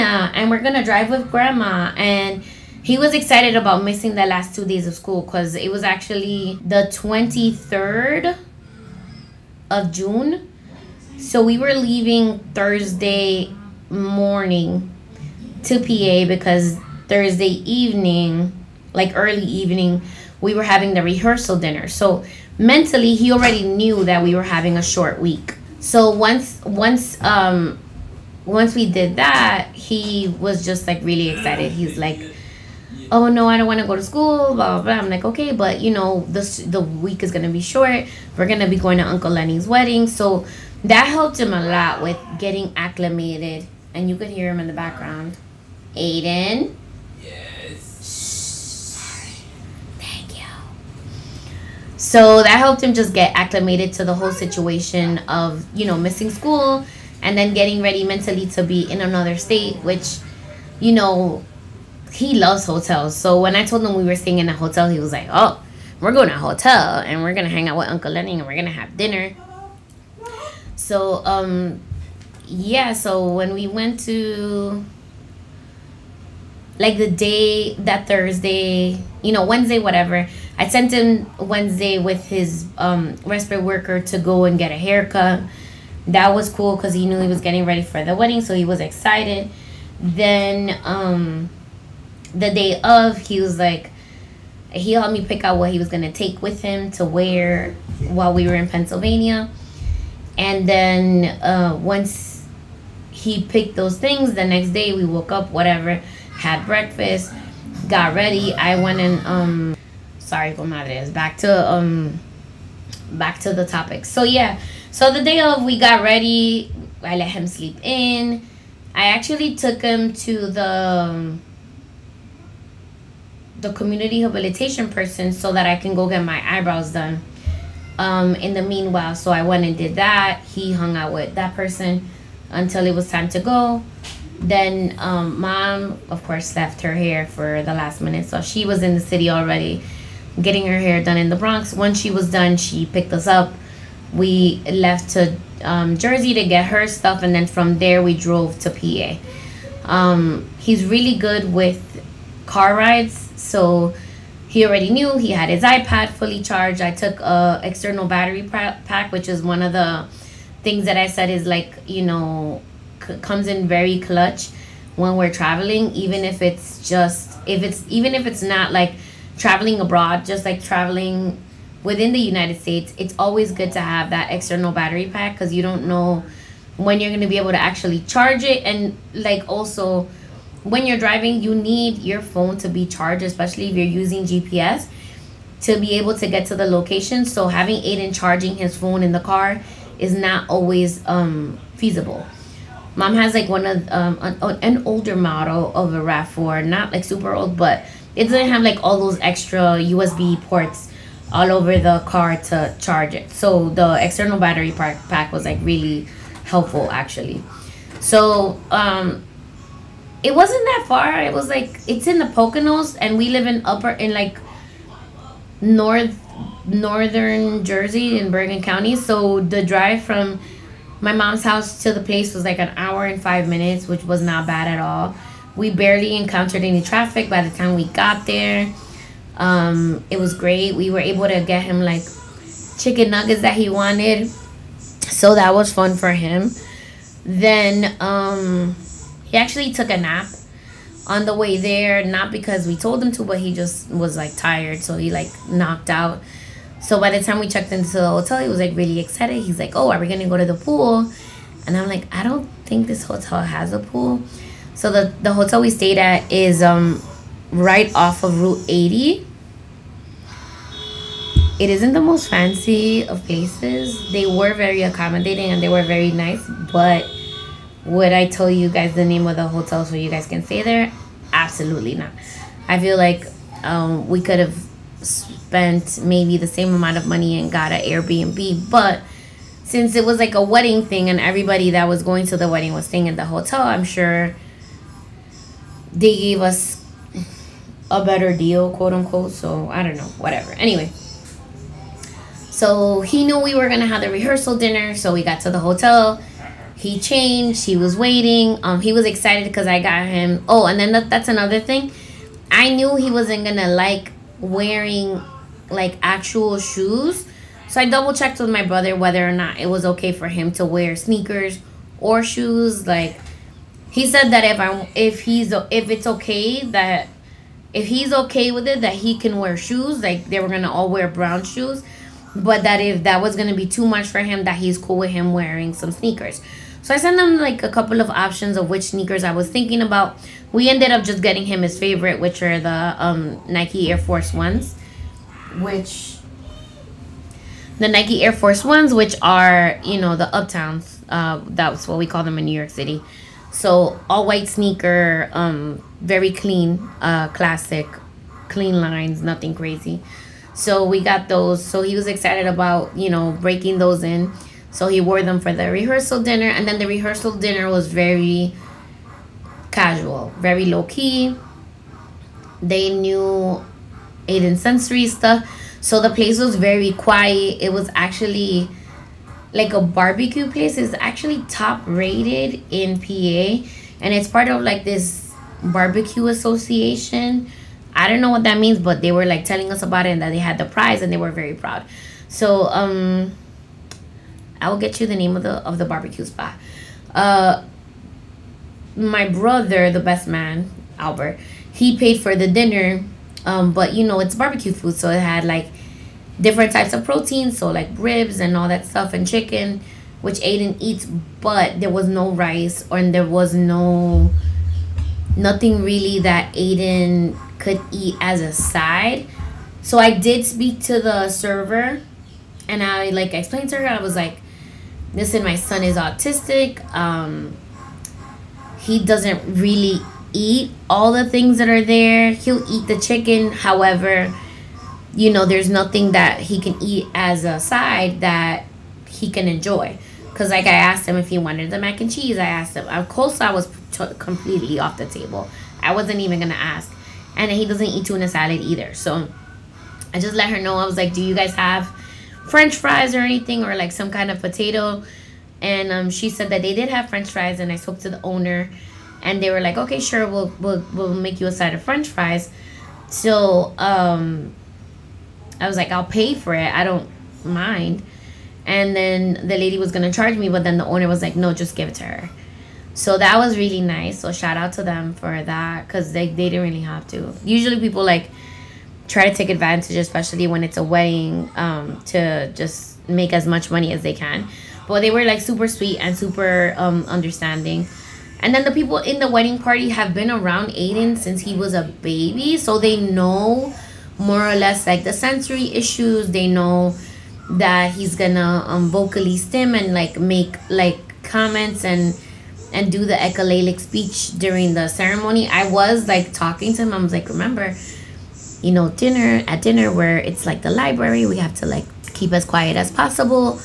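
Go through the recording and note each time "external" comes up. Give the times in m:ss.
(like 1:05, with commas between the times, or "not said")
2:37, 2:54, 3:24.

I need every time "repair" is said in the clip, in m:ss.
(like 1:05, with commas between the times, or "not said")
not said.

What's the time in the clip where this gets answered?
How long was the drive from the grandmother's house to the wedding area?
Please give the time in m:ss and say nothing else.
3:42.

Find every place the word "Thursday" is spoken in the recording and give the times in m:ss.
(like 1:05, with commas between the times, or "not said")
0:12, 0:17, 1:18.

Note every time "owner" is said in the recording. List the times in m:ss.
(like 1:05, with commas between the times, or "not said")
7:28, 7:40.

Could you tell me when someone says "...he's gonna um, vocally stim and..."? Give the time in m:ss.
8:07.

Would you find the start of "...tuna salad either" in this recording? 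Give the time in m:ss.
7:18.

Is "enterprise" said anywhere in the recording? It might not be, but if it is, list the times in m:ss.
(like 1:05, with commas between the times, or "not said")
not said.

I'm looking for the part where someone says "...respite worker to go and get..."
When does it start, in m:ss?
1:23.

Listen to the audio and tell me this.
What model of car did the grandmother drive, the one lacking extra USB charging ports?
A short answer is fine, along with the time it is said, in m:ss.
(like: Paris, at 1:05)
RAV4, at 3:15.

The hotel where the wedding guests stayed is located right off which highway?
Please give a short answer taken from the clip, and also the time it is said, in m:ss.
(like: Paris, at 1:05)
Route 80, at 4:18.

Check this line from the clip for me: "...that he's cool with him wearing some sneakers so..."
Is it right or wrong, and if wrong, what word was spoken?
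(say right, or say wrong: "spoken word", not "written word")
right.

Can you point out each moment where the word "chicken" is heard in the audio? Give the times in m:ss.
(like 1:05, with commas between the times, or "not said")
3:52, 6:39, 7:02.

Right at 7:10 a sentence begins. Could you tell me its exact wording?
Because, like, I asked him if he wanted the mac and cheese.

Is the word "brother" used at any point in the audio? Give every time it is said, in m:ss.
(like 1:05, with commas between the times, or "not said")
5:08, 6:29.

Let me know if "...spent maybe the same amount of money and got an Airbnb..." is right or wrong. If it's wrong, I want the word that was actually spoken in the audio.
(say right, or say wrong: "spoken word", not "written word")
right.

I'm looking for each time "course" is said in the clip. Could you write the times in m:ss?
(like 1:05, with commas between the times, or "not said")
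2:16, 7:13.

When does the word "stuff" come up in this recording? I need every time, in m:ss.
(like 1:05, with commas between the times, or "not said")
2:26, 6:05, 6:38.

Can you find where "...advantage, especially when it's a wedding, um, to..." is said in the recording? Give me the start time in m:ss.
7:49.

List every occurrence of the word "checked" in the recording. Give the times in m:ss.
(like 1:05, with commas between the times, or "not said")
4:07, 5:08.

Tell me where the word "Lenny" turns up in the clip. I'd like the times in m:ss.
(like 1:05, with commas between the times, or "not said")
0:39, 1:08.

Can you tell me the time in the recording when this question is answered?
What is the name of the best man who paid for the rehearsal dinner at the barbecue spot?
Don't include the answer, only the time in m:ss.
6:30.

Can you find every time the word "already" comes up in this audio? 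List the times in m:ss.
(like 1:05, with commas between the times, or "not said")
0:23, 2:19, 2:34.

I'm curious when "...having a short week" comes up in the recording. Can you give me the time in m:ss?
0:24.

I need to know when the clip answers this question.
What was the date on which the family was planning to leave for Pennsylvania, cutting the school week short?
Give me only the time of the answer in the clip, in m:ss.
0:06.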